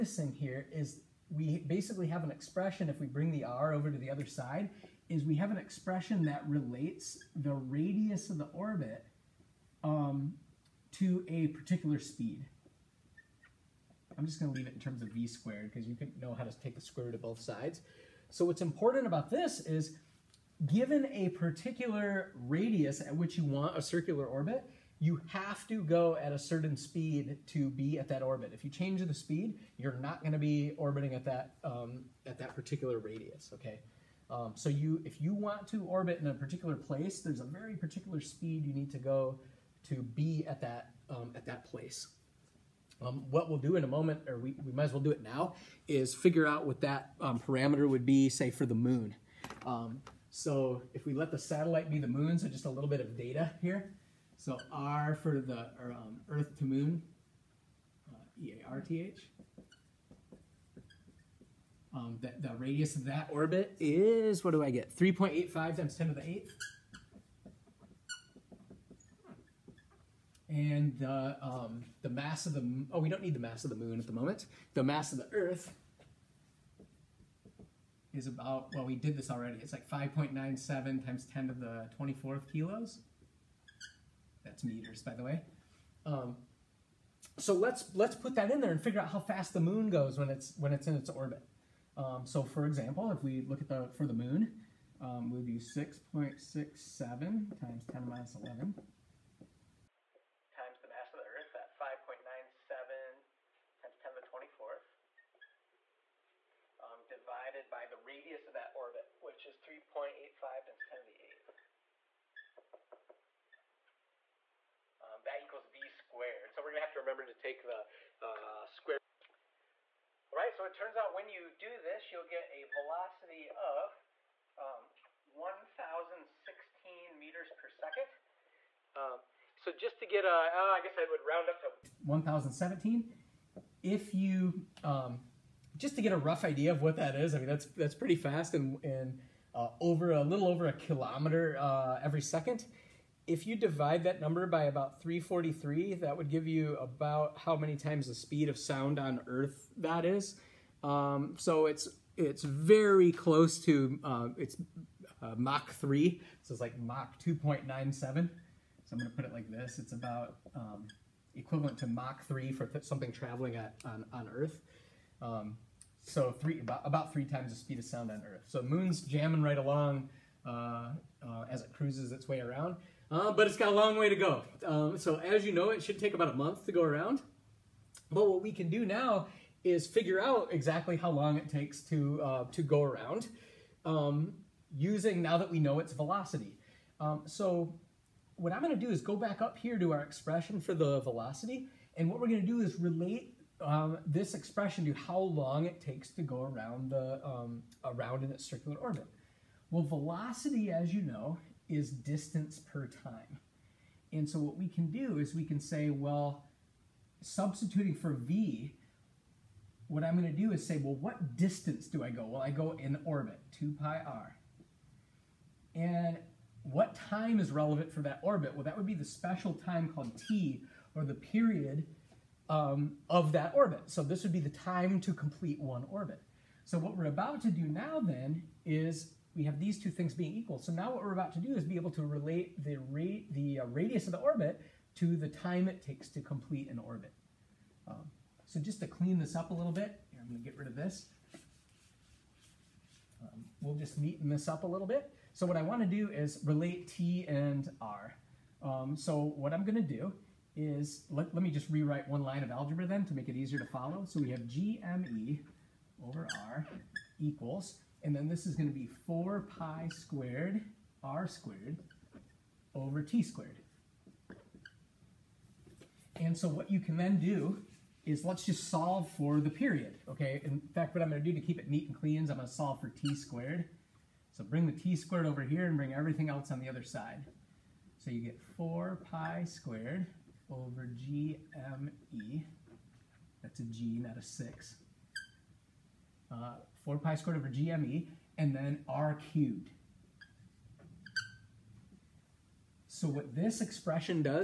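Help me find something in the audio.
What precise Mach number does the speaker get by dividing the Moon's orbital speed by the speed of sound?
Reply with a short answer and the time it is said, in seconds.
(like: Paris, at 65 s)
Mach 2.97, at 156 s.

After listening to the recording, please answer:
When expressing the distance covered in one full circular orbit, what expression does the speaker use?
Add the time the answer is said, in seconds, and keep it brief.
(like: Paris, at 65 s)
2 pi r, at 213 s.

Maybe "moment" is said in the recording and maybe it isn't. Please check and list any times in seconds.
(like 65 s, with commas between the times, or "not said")
43 s, 74 s.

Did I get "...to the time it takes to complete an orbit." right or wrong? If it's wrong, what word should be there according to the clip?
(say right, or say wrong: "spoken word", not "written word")
right.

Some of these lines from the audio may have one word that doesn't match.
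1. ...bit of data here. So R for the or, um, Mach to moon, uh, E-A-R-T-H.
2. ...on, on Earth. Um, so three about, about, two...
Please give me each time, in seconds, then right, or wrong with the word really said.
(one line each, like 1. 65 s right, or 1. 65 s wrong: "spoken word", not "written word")
1. 52 s wrong: "Earth", not "Mach"
2. 163 s wrong: "three", not "two".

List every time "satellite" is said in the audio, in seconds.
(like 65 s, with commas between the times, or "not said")
51 s.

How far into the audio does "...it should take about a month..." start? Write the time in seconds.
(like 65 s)
175 s.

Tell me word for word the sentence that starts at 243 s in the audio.
Um, we'll just neaten this up a little bit.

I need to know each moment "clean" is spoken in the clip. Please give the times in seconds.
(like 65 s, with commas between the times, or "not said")
238 s, 271 s.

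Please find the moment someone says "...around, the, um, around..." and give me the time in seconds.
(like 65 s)
196 s.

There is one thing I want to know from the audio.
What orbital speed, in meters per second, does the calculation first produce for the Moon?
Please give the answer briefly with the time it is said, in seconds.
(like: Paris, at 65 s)
1,016, at 125 s.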